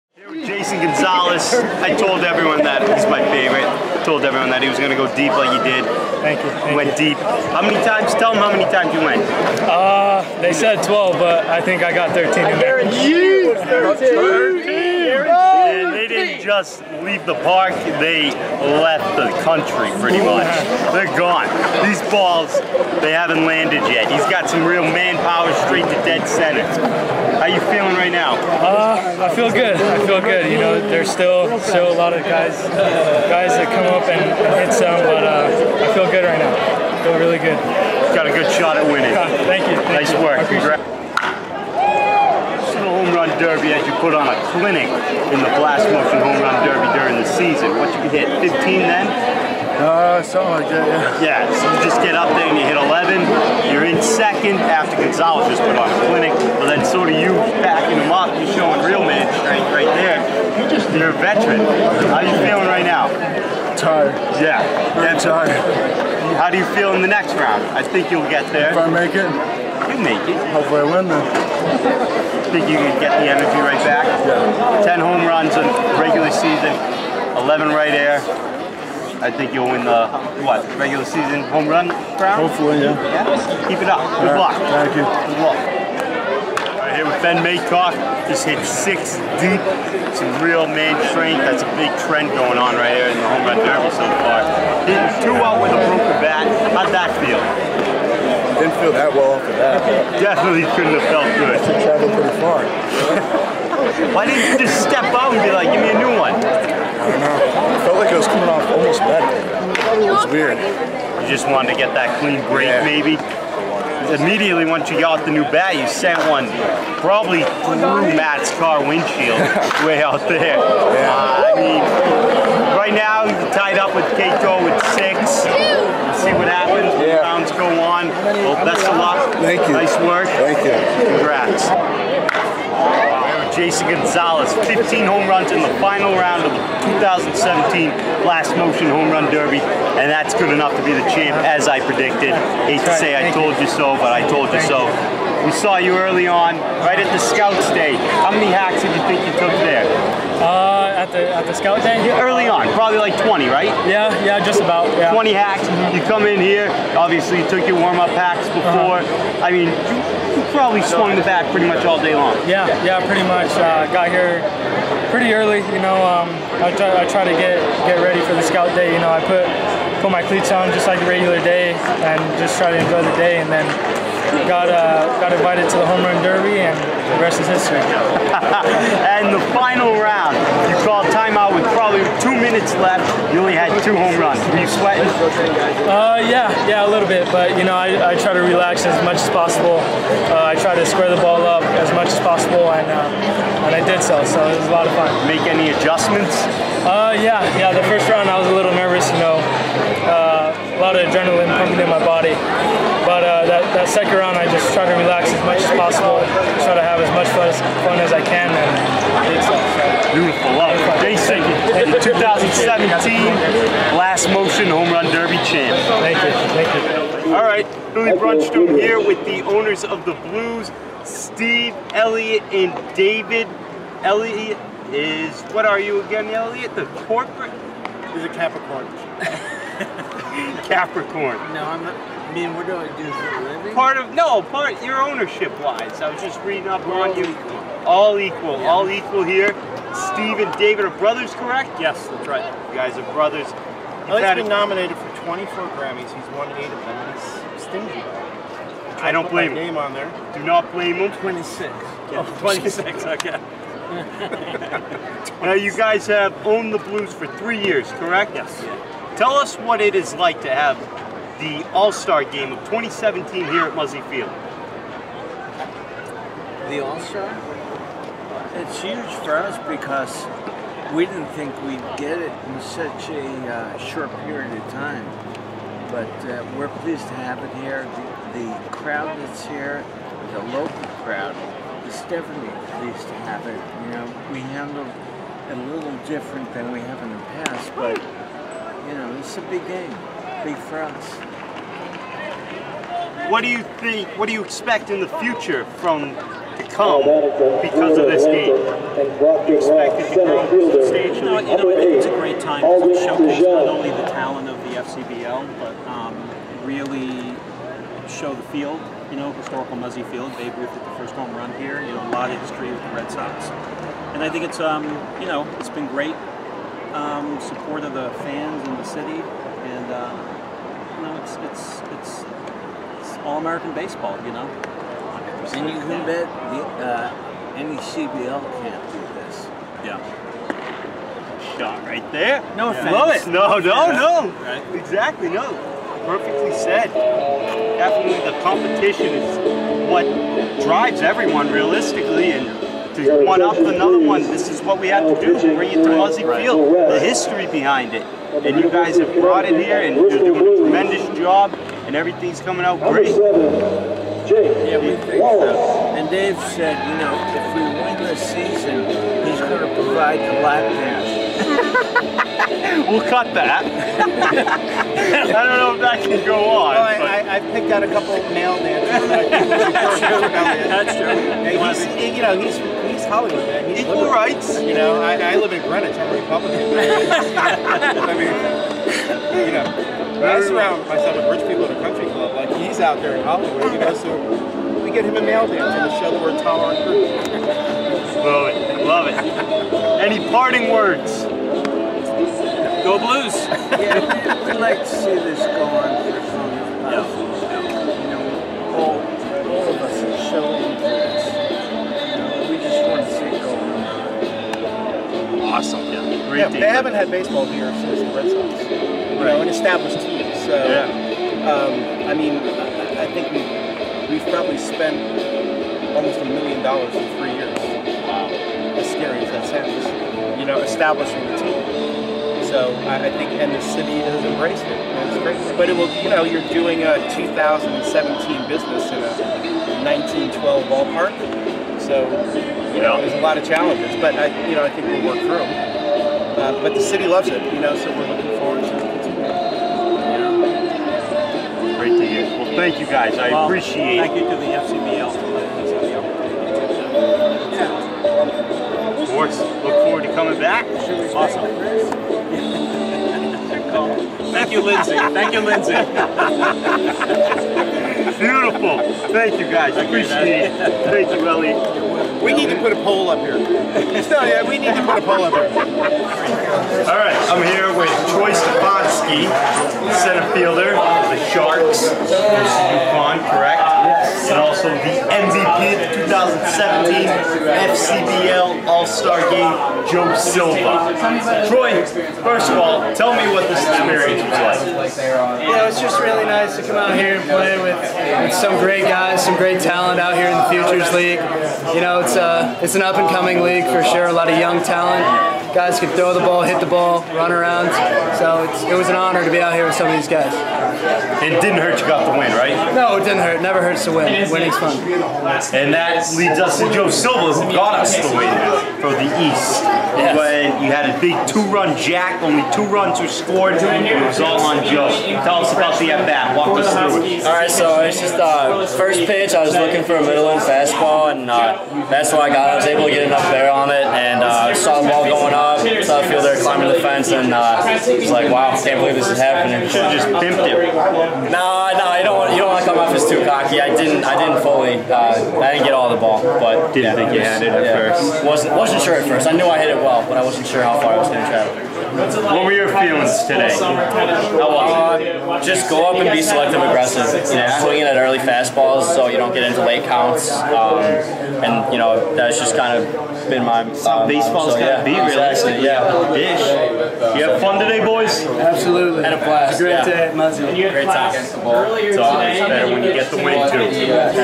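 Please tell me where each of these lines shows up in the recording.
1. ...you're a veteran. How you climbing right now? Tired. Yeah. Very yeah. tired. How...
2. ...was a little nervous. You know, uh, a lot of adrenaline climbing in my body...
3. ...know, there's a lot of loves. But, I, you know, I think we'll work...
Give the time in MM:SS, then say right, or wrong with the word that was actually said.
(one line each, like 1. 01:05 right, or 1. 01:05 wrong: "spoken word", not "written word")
1. 01:00 wrong: "feeling", not "climbing"
2. 03:18 wrong: "pumping", not "climbing"
3. 07:12 wrong: "challenges", not "loves".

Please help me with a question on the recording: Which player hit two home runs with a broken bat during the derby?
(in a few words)
Ben Maycock.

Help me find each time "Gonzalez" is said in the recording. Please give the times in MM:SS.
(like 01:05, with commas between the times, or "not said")
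00:00, 00:55, 02:13.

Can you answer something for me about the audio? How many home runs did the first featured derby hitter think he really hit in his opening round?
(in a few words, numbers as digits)
13.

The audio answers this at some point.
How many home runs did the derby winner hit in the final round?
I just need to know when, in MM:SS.
02:14.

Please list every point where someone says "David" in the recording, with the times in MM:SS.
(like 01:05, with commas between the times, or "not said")
03:42, 04:00.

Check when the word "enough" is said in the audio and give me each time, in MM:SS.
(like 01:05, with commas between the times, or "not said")
02:20, 08:43.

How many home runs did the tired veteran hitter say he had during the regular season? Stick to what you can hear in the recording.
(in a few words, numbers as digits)
10.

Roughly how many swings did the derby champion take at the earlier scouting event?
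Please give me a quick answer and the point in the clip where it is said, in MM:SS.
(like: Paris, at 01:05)
20, at 02:35.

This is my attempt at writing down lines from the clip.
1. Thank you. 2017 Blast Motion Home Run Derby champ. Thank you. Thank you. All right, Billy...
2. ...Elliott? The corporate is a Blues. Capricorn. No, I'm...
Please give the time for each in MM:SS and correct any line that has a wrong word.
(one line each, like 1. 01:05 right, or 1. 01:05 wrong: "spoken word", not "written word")
1. 03:31 right
2. 03:46 wrong: "Capricorn", not "Blues".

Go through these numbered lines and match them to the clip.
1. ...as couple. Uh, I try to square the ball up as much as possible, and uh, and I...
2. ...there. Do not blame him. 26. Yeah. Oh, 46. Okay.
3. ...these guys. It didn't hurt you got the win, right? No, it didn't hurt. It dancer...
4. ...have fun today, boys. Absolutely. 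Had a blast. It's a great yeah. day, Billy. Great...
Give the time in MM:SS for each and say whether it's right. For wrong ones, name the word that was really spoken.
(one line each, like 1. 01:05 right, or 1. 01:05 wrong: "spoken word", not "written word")
1. 03:09 wrong: "possible", not "couple"
2. 04:09 wrong: "26", not "46"
3. 08:19 wrong: "never", not "dancer"
4. 09:17 wrong: "Muzzy", not "Billy".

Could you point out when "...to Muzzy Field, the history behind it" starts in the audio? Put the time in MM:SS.
05:45.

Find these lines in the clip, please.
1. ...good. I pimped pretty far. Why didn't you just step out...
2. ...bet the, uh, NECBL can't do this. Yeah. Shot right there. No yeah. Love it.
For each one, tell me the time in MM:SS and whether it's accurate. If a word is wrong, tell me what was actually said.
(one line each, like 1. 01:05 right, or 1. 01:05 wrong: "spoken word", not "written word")
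1. 01:41 wrong: "traveled", not "pimped"
2. 05:26 right.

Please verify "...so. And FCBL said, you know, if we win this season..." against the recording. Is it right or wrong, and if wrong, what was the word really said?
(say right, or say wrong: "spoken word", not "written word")
wrong: "Dave", not "FCBL".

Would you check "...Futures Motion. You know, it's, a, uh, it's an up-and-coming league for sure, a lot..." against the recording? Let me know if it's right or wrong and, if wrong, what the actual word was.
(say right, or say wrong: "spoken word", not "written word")
wrong: "League", not "Motion".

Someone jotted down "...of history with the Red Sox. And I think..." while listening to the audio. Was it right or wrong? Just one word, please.
right.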